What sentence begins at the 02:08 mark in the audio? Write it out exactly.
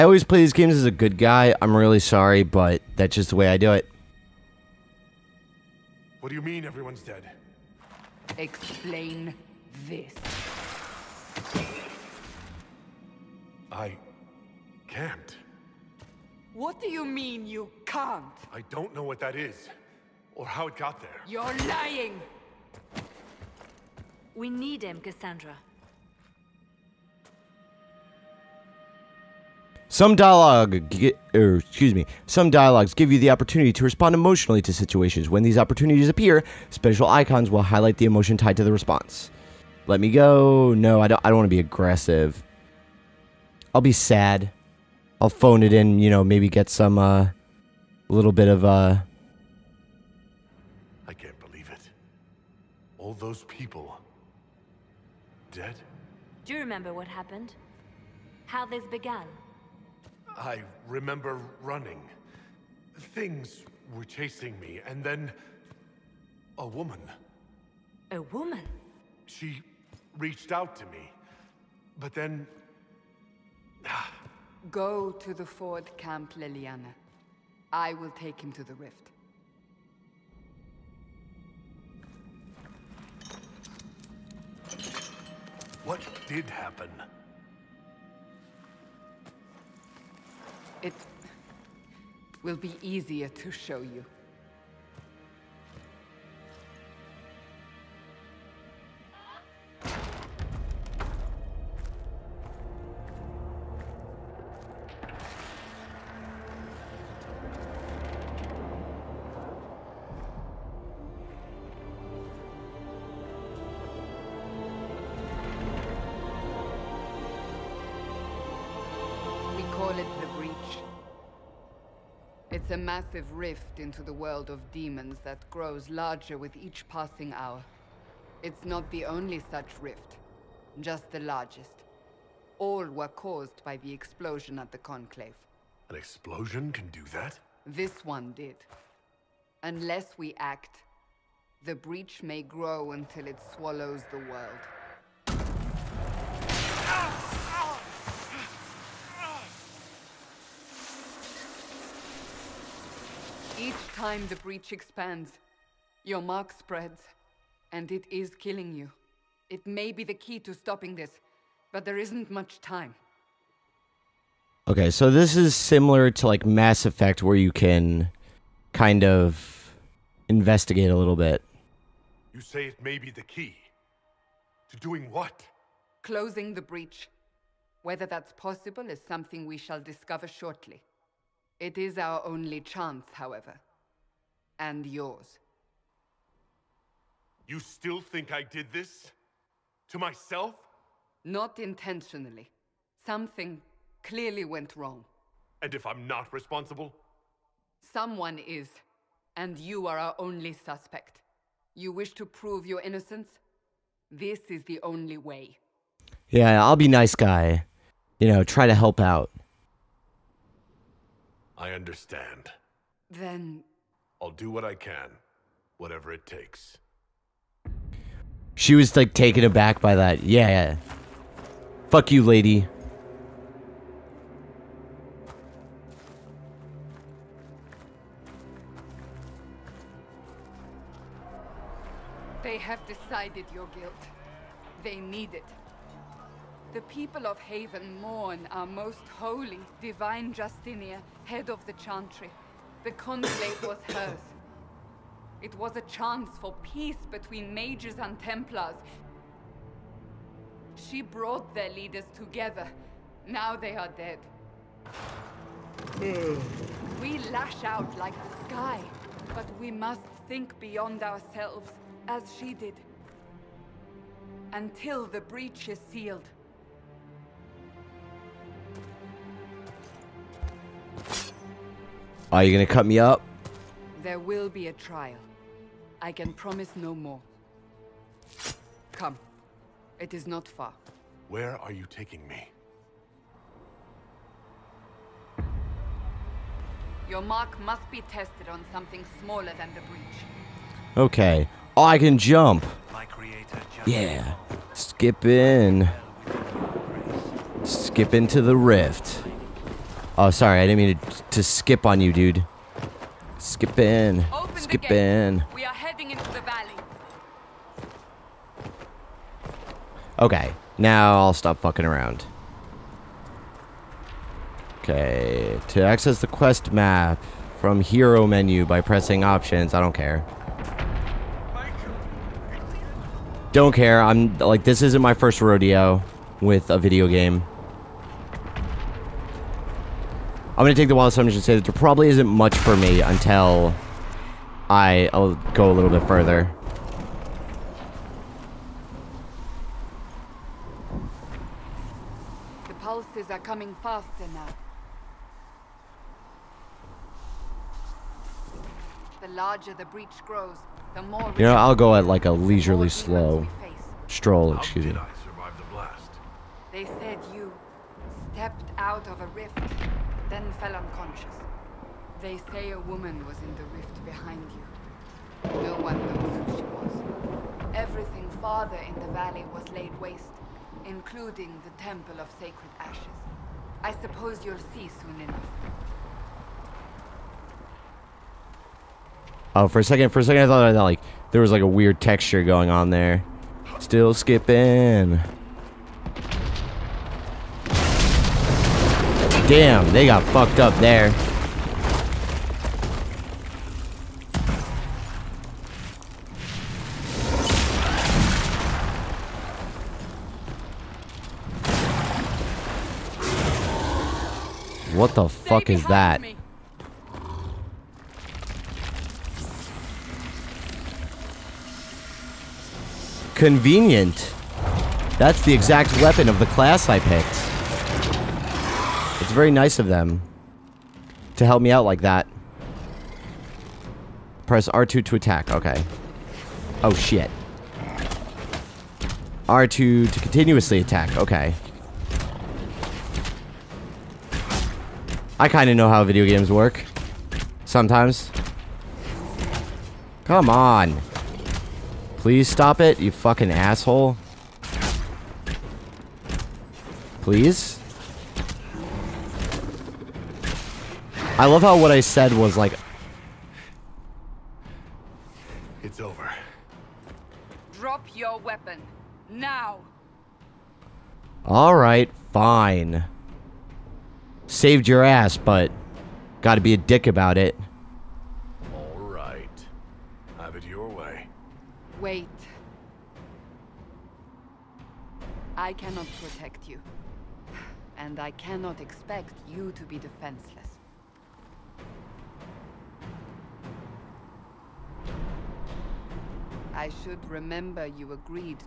It's not the only such rift, just the largest.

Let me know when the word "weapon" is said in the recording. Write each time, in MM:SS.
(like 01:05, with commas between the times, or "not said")
06:56, 07:38.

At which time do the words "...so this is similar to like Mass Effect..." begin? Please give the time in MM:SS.
02:44.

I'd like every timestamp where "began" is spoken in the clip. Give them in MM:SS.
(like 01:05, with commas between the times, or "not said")
00:58.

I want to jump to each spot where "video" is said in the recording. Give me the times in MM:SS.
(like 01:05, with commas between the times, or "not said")
05:26, 07:16.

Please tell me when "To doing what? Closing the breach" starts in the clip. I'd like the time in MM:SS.
02:54.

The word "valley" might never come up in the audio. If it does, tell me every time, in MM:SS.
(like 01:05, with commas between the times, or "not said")
05:06, 06:09.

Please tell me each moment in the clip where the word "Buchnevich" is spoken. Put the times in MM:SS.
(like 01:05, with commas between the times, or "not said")
not said.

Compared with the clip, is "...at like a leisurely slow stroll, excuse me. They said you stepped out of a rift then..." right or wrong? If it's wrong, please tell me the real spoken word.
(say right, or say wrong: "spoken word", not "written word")
right.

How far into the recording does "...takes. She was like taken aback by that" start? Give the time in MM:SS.
03:36.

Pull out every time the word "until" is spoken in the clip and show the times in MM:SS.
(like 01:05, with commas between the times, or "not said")
02:22, 04:24, 05:33.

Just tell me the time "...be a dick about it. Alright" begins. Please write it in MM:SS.
07:46.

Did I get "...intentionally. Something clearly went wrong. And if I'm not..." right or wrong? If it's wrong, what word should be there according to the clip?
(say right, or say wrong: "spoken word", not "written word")
right.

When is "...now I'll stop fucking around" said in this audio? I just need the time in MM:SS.
05:10.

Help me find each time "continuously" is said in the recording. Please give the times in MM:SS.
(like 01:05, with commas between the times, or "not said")
07:10.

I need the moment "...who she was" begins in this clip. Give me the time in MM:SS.
06:06.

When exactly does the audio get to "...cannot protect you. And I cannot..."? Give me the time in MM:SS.
07:55.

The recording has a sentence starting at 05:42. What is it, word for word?
The pulses are coming faster now.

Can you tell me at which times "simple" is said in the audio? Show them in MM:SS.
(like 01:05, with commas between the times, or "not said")
not said.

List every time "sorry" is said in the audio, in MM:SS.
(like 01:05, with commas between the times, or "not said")
00:01, 05:00.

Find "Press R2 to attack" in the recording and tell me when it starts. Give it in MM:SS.
07:04.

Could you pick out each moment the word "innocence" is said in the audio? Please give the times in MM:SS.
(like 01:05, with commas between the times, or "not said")
03:22.